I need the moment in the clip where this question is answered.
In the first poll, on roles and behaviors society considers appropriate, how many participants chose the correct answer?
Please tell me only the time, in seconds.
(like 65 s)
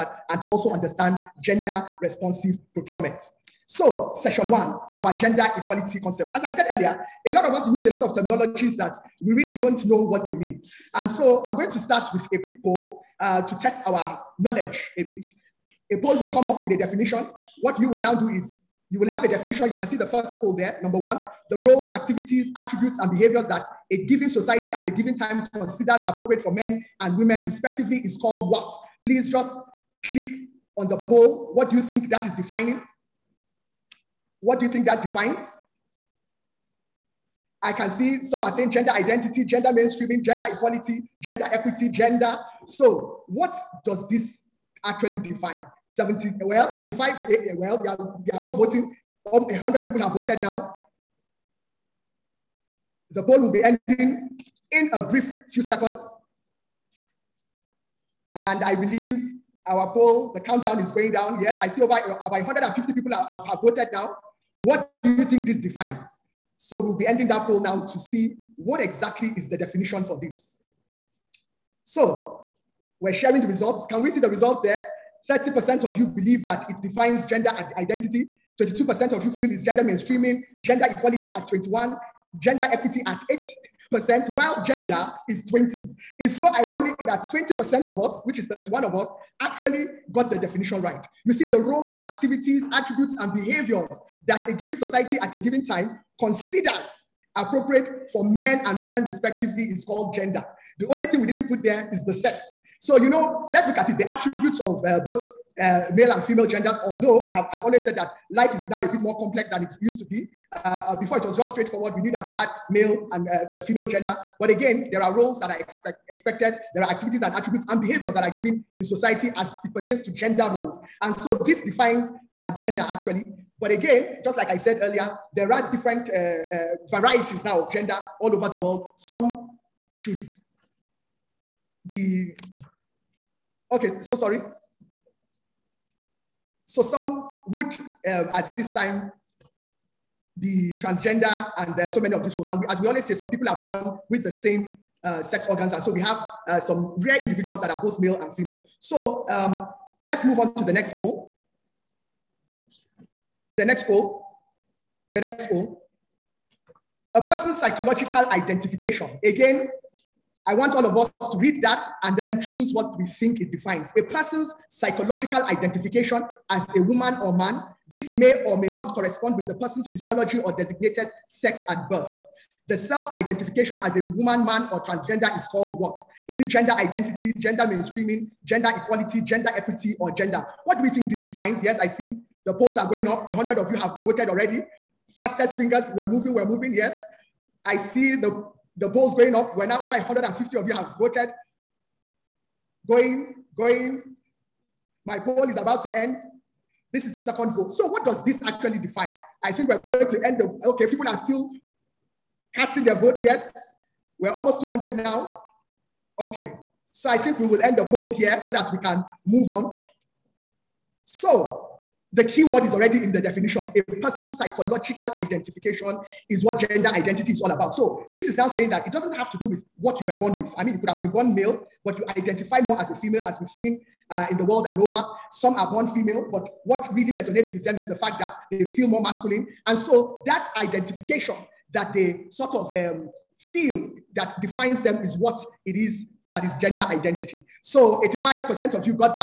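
88 s.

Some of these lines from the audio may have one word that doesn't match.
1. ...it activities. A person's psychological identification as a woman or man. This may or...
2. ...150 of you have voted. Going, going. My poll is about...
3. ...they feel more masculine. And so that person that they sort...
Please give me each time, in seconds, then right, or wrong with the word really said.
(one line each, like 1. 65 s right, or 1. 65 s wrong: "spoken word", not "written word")
1. 163 s wrong: "defines", not "activities"
2. 189 s right
3. 228 s wrong: "identification", not "person".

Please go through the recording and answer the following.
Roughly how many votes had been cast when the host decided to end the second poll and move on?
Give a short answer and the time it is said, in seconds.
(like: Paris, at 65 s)
almost 200, at 204 s.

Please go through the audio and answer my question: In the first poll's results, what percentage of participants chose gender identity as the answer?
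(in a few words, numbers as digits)
30%.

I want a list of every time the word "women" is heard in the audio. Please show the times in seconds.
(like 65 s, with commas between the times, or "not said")
27 s, 98 s.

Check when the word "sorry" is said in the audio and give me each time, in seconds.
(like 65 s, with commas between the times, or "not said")
134 s.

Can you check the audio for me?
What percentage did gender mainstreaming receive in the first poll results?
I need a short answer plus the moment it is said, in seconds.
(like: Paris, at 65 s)
22%, at 78 s.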